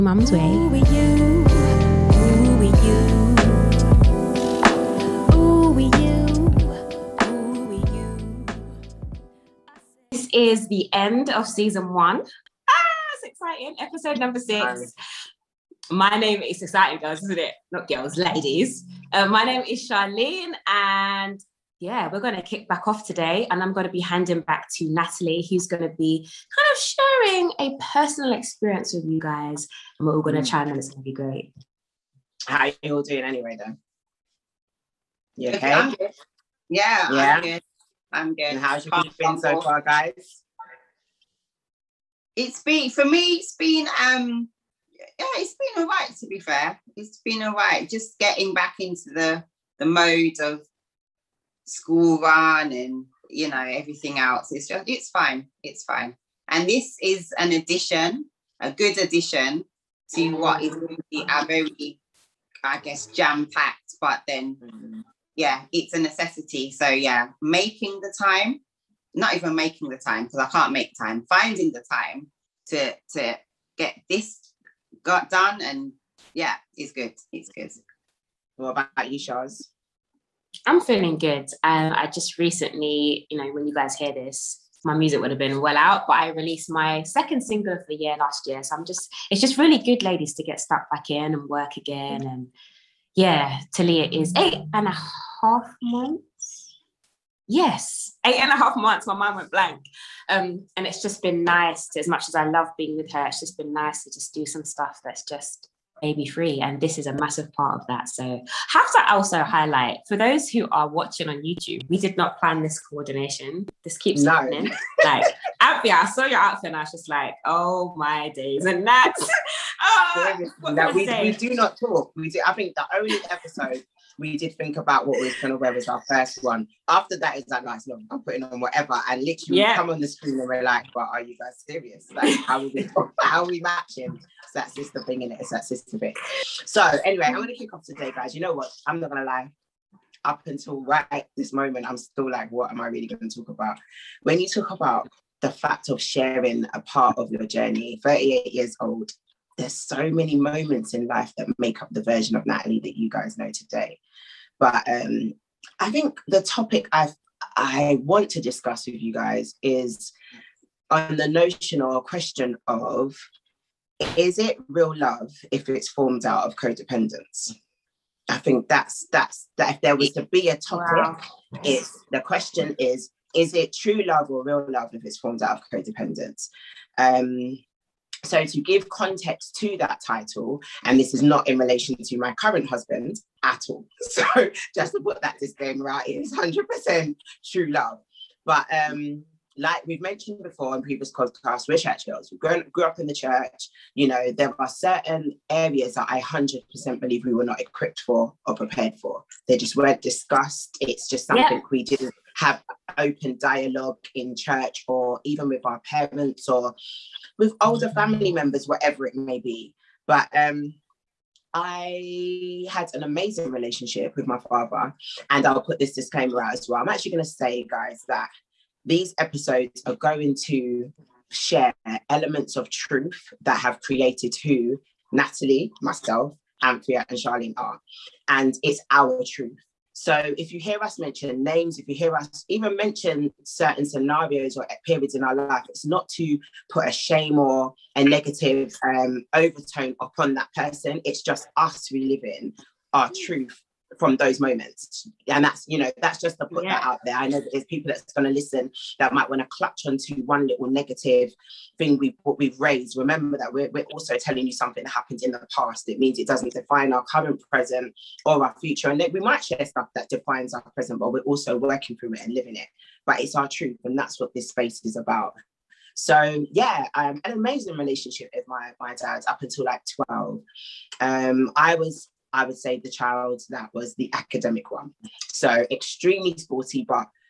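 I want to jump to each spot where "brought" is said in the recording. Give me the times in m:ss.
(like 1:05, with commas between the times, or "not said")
not said.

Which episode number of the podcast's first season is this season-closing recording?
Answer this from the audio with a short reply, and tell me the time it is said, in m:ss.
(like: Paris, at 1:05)
6, at 0:14.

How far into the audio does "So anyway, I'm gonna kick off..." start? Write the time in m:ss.
2:16.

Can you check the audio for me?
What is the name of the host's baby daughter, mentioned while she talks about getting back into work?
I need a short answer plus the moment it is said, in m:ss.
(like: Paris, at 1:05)
Talia, at 1:33.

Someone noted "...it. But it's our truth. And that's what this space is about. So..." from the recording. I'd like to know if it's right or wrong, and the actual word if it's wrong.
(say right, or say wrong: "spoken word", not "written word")
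right.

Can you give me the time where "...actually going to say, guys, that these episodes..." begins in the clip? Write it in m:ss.
3:36.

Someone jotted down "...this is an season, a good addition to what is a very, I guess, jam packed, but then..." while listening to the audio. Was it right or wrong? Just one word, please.
wrong.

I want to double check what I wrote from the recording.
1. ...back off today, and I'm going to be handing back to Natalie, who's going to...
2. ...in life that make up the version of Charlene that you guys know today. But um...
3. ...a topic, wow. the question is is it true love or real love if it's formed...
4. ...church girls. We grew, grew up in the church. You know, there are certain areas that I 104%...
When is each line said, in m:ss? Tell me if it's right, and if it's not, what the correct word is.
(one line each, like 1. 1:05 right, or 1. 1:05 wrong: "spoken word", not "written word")
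1. 0:22 right
2. 2:30 wrong: "Natalie", not "Charlene"
3. 2:50 right
4. 3:11 wrong: "100", not "104".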